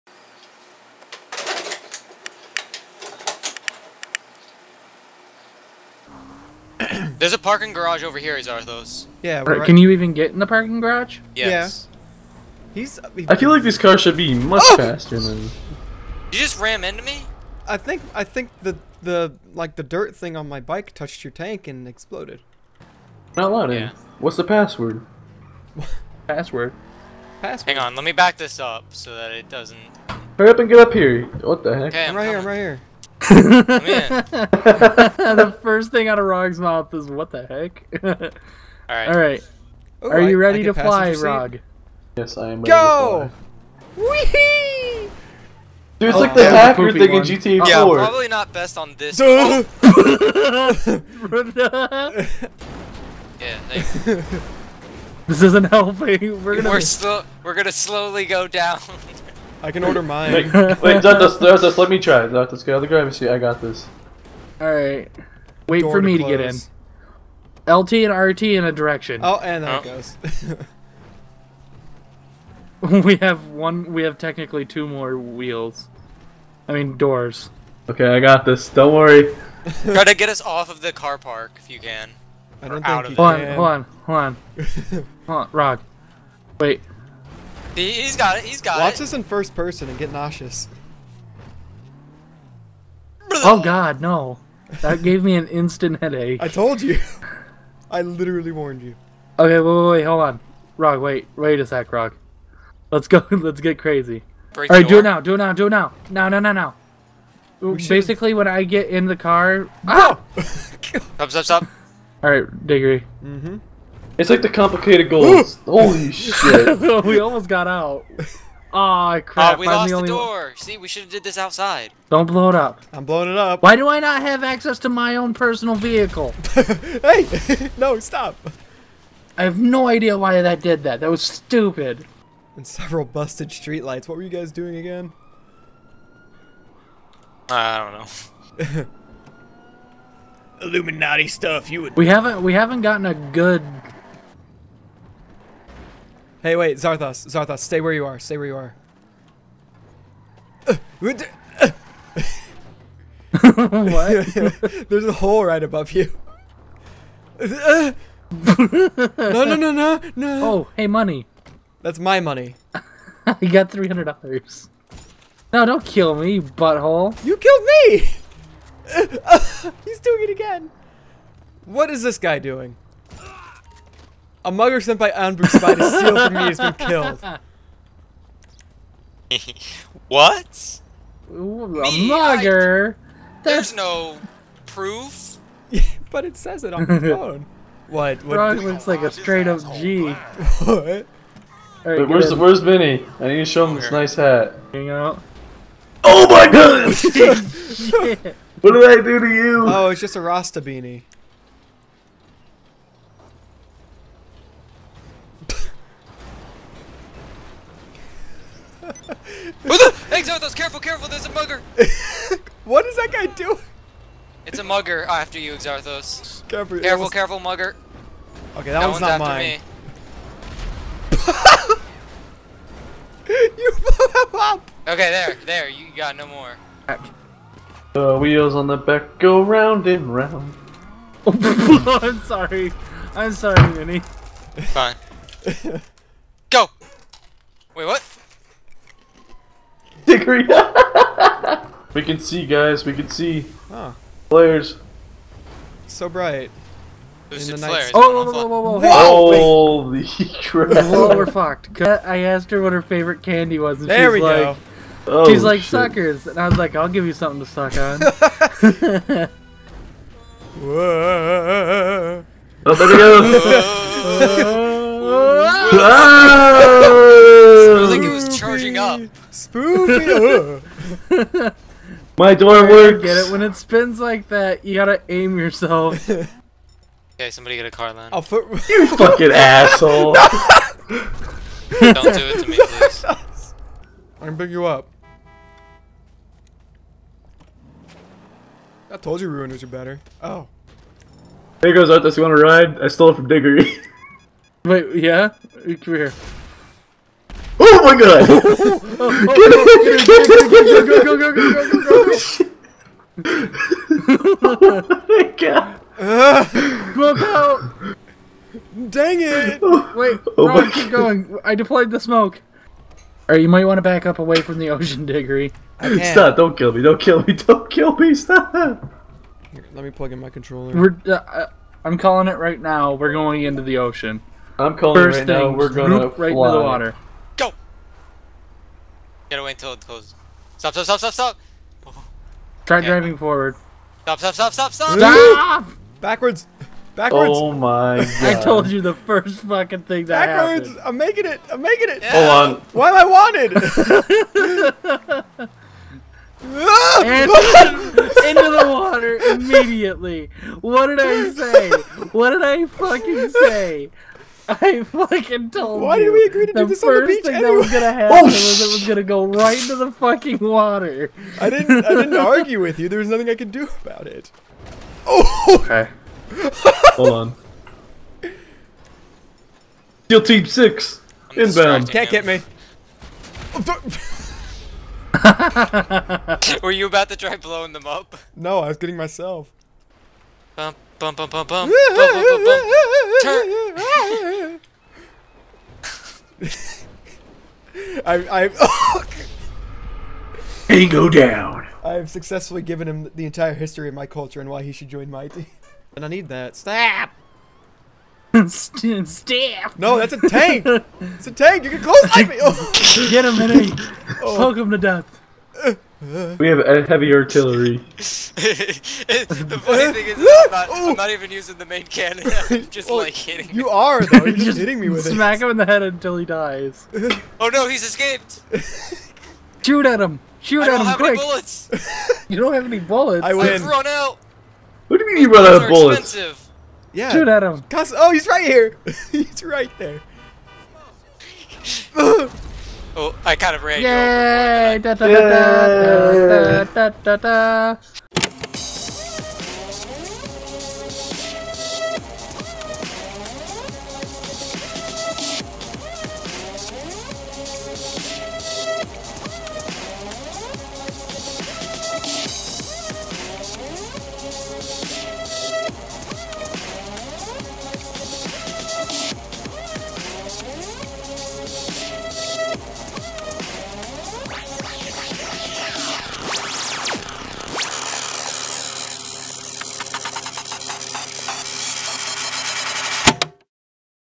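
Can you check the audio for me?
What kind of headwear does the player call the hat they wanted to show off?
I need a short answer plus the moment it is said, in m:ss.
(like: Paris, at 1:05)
Rasta beanie, at 3:20.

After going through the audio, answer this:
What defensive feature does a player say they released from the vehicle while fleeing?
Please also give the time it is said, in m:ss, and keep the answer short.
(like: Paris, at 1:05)
smoke, at 5:11.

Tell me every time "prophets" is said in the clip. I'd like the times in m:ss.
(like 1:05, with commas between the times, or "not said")
not said.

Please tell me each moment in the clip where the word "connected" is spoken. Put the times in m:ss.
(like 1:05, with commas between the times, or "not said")
not said.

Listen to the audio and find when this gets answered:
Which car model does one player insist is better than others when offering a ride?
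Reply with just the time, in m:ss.
4:49.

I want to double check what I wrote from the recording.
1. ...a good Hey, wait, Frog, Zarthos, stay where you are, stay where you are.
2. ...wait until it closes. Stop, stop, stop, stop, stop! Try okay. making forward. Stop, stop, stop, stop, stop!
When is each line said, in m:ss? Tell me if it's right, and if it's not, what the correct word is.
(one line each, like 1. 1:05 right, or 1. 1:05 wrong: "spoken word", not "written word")
1. 2:23 wrong: "Zarthos", not "Frog"
2. 5:29 wrong: "driving", not "making".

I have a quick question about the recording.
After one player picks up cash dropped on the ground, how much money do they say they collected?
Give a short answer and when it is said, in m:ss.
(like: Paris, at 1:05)
$300, at 2:43.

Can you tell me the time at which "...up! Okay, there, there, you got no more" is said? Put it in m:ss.
3:44.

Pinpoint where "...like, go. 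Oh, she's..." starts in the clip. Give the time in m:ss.
4:14.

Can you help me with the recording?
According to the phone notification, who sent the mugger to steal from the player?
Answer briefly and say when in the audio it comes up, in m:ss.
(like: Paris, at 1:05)
Ambush Spy, at 2:55.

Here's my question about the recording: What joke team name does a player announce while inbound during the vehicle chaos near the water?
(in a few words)
Steel team six.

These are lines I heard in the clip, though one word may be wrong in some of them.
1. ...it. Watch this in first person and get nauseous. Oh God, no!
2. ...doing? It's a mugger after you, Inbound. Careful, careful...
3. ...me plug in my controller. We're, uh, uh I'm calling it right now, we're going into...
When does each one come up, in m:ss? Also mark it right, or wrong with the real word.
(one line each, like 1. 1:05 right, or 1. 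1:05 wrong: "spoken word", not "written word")
1. 1:28 right
2. 3:33 wrong: "Exarthos", not "Inbound"
3. 5:19 right.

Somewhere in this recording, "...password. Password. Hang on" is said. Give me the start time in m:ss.
0:26.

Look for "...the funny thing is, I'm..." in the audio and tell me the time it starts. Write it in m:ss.
6:47.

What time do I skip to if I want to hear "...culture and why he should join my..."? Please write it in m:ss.
6:34.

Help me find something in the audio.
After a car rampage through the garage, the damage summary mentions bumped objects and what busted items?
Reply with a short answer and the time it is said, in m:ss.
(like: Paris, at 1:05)
streetlights, at 2:12.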